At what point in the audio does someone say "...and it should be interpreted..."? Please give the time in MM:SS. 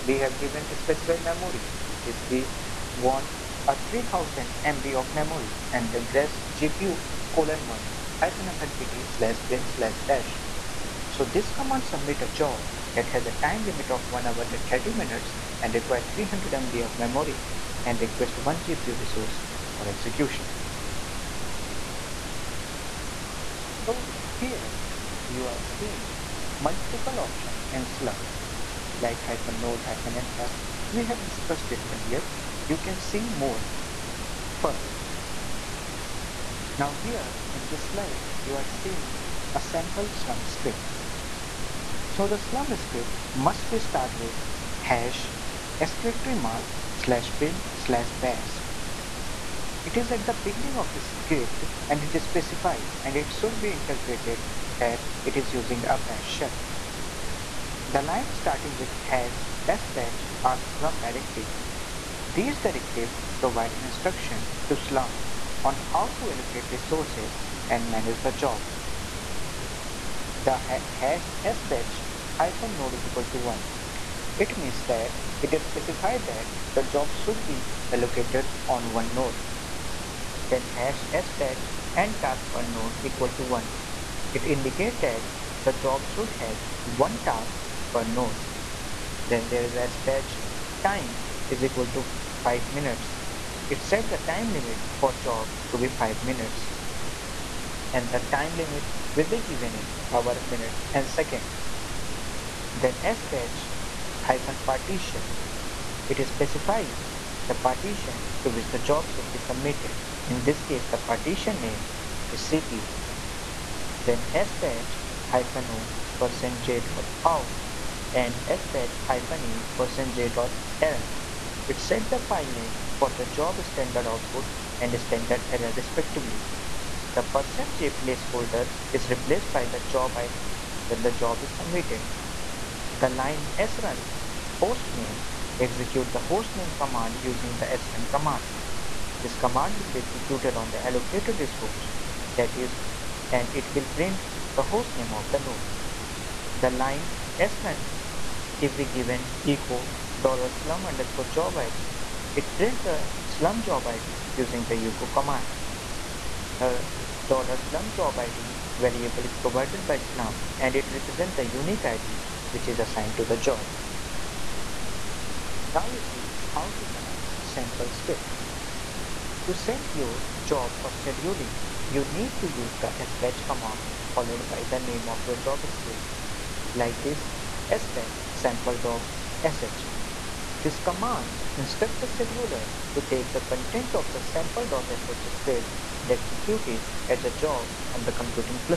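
00:53.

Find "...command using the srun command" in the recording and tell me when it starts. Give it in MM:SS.
02:16.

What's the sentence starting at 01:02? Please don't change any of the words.
These directive provide instruction to Slurm on how to allocate resources and manage the job.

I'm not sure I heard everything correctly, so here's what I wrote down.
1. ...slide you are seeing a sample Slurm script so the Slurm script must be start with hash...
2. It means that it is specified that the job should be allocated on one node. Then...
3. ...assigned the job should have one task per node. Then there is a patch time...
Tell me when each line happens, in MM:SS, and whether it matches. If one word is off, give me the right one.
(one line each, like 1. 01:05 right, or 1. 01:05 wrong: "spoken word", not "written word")
1. 00:37 right
2. 01:14 right
3. 01:24 wrong: "indicated", not "assigned".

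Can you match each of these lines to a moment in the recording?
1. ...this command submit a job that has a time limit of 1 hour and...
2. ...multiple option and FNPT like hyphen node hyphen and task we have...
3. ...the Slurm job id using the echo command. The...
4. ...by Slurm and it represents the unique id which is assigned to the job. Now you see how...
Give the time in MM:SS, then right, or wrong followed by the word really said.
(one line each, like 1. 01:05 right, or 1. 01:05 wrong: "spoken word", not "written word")
1. 00:11 right
2. 00:26 wrong: "Slurm", not "FNPT"
3. 02:32 right
4. 02:39 right.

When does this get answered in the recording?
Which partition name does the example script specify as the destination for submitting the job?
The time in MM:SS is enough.
01:52.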